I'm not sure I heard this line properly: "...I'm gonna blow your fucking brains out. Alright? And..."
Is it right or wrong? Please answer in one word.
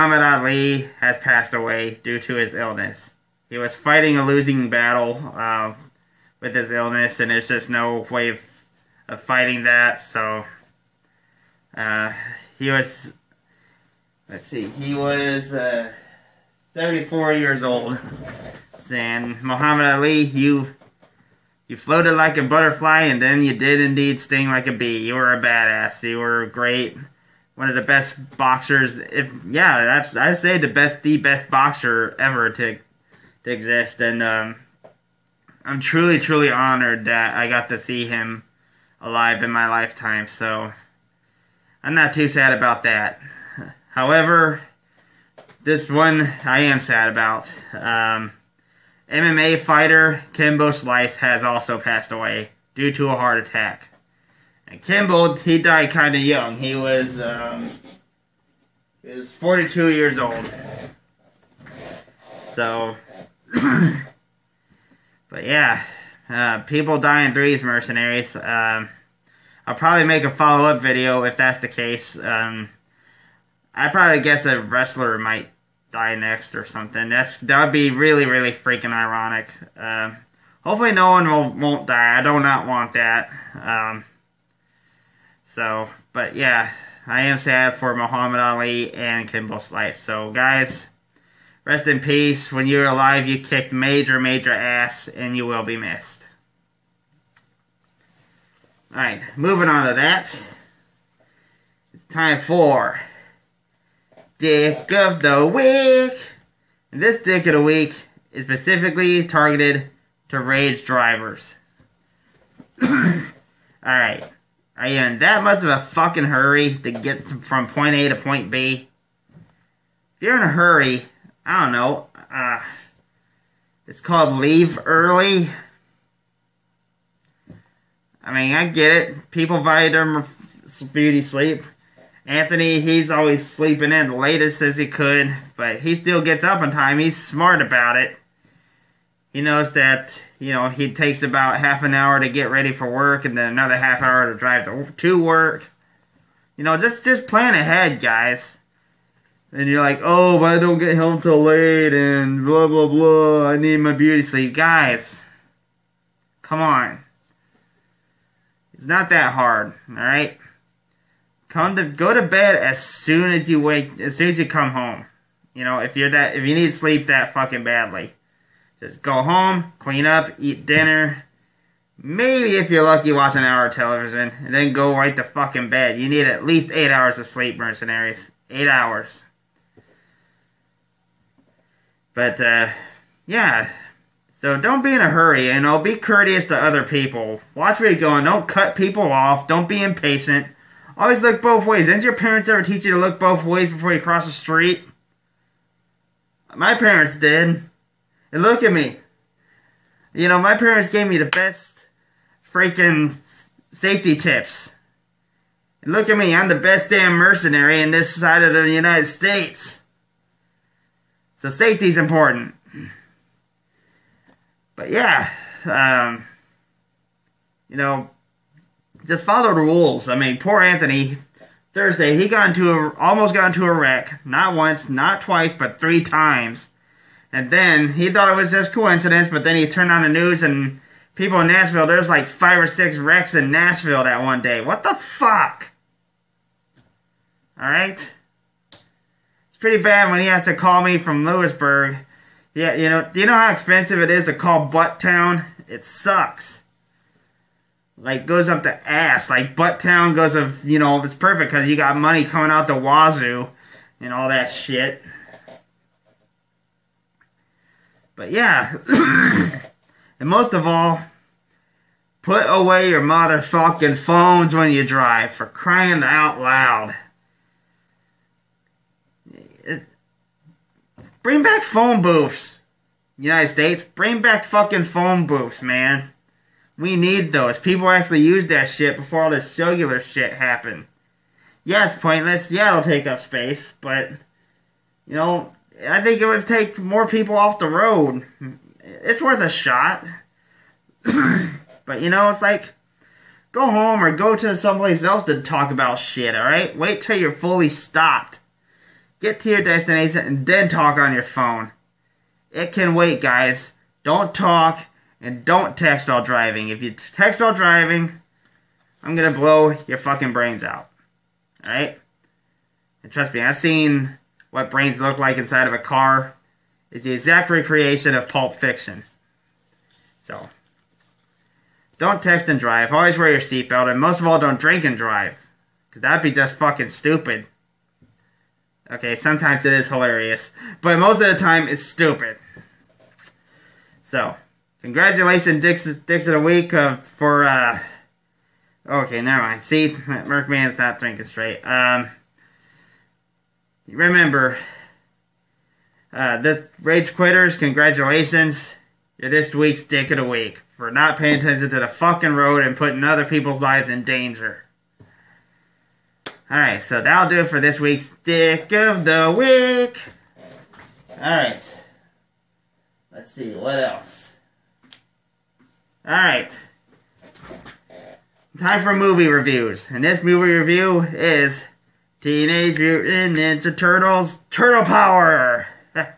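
right.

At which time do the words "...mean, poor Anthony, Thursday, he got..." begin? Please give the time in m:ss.
3:40.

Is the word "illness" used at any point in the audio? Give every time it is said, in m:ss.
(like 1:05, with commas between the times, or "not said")
0:02, 0:06.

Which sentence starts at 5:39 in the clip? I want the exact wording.
See, Merc Man's not drinking straight.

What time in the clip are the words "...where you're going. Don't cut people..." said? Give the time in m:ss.
3:07.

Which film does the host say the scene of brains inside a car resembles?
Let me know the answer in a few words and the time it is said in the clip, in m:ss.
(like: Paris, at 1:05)
Pulp Fiction, at 5:18.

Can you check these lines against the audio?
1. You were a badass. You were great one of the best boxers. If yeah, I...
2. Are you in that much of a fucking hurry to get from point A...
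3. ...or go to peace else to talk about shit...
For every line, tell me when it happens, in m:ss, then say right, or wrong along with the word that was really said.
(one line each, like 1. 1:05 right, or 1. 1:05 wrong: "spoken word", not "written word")
1. 0:25 right
2. 1:54 right
3. 4:54 wrong: "someplace", not "peace".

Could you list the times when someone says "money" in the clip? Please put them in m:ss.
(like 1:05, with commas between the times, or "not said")
4:11.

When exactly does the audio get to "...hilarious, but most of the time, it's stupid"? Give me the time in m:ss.
5:29.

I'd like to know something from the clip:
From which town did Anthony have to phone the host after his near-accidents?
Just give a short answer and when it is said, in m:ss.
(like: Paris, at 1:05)
Lewisburg, at 4:01.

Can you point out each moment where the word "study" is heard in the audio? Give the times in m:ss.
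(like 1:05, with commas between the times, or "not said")
not said.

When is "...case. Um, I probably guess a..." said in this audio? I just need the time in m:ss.
1:11.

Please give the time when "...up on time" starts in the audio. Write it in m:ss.
2:16.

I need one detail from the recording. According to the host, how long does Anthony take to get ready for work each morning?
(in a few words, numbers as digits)
half an hour.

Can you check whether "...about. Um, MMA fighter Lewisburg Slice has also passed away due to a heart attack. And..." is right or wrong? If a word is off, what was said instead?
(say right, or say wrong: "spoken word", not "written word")
wrong: "Kimbo", not "Lewisburg".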